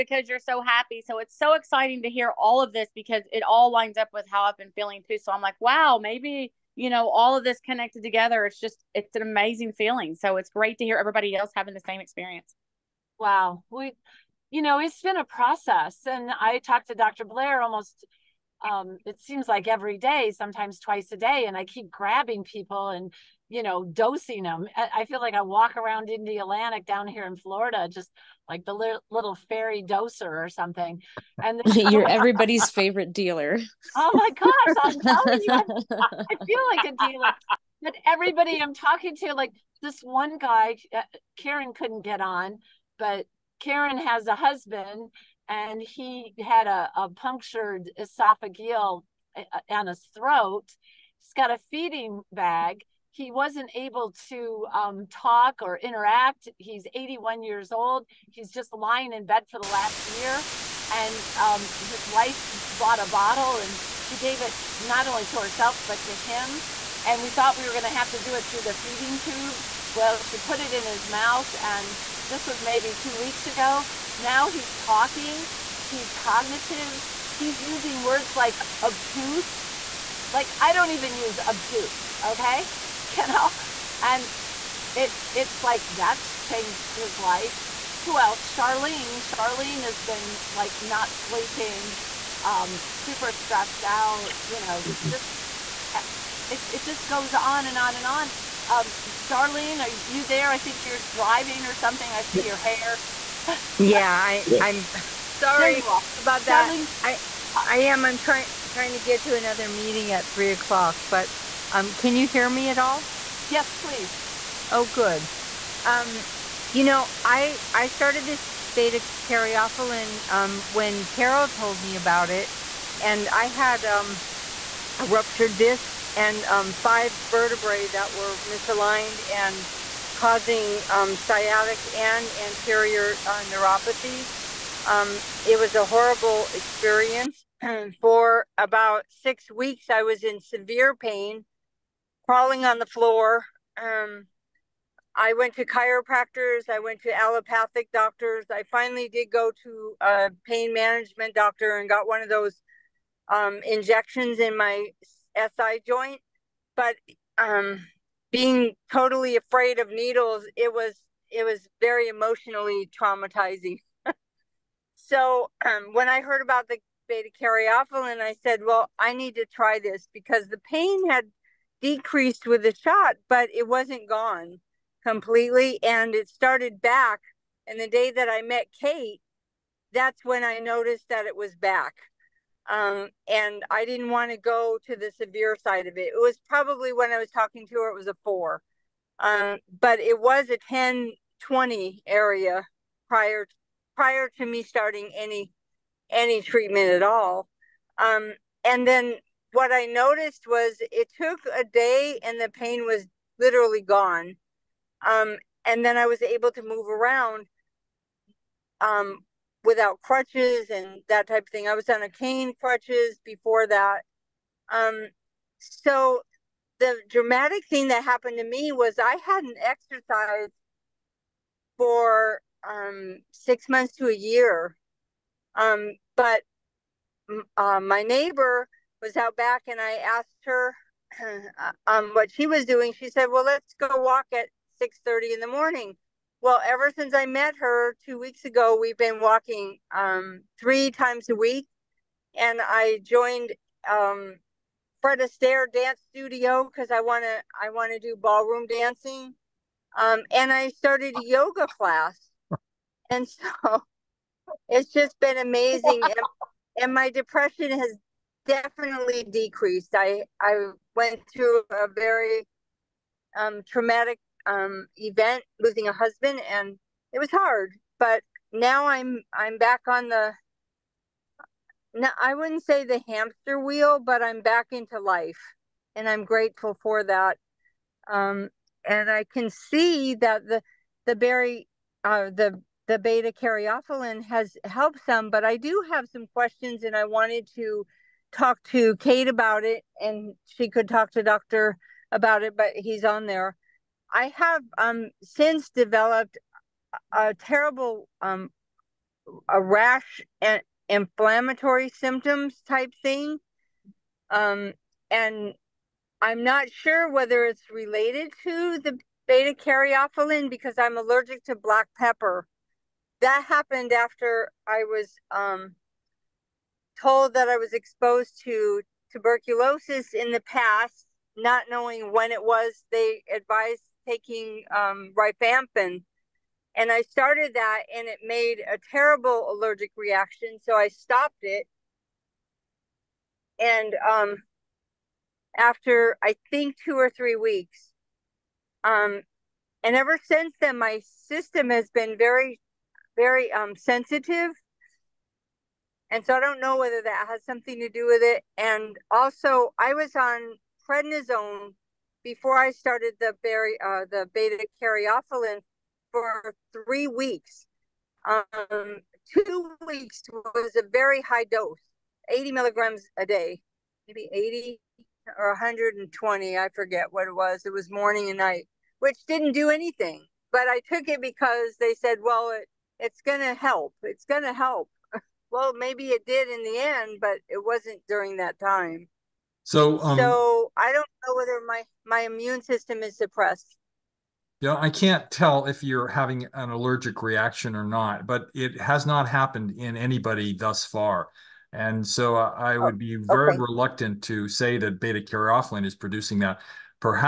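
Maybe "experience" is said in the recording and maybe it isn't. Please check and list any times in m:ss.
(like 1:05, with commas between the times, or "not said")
0:12, 2:16.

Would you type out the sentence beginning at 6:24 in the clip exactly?
Yeah, I can't tell if you're having an allergic reaction or not, but it has not happened in anybody thus far.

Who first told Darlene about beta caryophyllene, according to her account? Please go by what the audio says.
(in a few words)
Carol.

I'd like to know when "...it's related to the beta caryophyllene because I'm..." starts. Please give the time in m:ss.
5:07.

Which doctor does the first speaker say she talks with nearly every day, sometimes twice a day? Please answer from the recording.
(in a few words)
Dr. Blair.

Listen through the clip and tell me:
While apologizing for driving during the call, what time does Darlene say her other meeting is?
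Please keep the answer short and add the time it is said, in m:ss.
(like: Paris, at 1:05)
3 o'clock, at 1:50.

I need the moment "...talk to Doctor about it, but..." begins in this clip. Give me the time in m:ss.
4:50.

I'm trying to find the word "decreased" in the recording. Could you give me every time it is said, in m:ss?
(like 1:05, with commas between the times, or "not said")
2:51, 4:19.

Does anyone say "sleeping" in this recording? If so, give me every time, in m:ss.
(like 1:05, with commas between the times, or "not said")
1:31.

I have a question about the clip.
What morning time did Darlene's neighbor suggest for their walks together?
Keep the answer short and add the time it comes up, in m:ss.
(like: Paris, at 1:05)
6:30, at 3:54.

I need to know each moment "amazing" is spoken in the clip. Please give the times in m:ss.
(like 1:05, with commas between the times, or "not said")
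0:09, 4:15.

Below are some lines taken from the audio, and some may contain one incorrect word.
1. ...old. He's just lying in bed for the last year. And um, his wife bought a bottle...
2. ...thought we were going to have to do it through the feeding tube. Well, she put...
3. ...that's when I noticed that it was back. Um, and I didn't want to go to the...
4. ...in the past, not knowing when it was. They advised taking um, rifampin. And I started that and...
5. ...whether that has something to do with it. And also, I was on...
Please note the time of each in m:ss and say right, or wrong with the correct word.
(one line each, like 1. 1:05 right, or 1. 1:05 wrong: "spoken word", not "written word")
1. 0:57 right
2. 1:07 right
3. 2:59 right
4. 5:20 right
5. 5:46 right.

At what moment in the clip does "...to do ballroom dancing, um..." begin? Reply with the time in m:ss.
4:07.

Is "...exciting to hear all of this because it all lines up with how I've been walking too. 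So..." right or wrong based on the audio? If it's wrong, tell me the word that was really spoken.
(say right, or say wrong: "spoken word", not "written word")
wrong: "feeling", not "walking".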